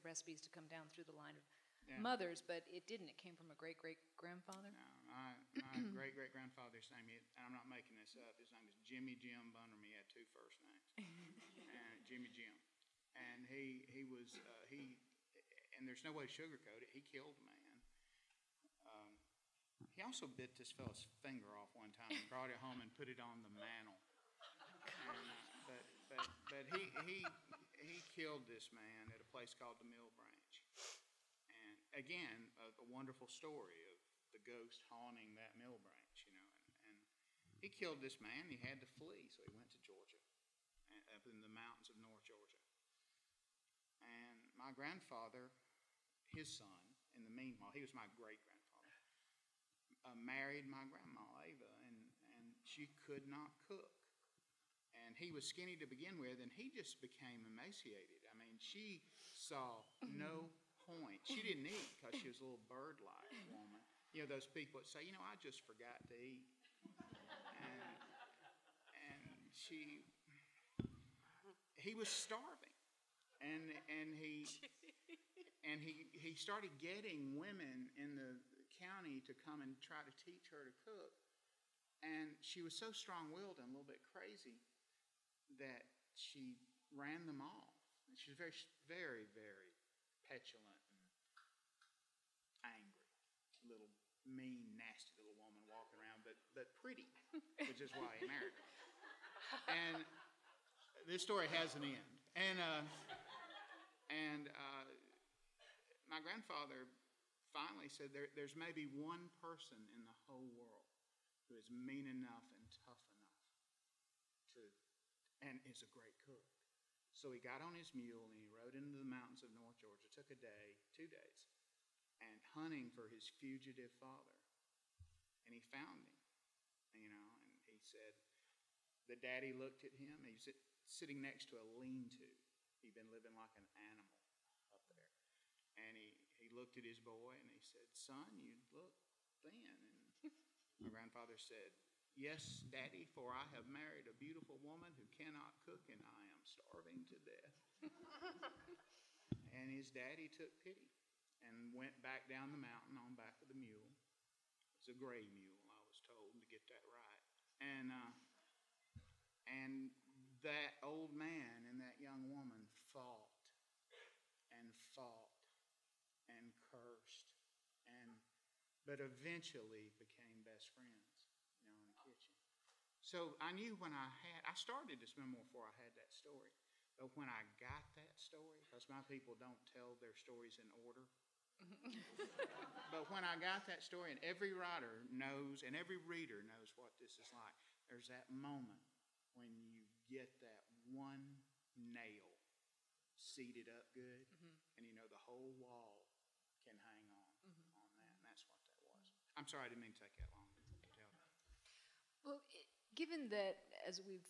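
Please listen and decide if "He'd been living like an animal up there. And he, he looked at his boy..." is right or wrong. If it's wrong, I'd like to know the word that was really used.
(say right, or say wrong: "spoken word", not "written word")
right.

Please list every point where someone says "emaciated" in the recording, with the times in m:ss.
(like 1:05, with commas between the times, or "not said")
0:57.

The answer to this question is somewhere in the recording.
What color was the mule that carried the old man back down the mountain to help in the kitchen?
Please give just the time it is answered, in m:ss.
2:34.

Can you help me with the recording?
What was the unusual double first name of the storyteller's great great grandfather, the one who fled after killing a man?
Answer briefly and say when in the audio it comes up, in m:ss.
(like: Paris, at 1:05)
Jimmy Jim Bunderman, at 0:08.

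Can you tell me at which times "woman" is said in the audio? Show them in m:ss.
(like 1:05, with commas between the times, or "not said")
1:03, 2:24, 2:42.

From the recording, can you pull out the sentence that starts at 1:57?
So he got on his mule and he rode into the mountains of North Georgia.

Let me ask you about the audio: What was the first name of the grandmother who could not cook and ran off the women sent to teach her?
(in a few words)
Ava.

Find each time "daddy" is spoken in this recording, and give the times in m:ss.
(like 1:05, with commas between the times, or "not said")
2:09, 2:22, 2:29.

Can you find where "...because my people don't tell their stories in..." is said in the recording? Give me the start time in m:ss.
2:58.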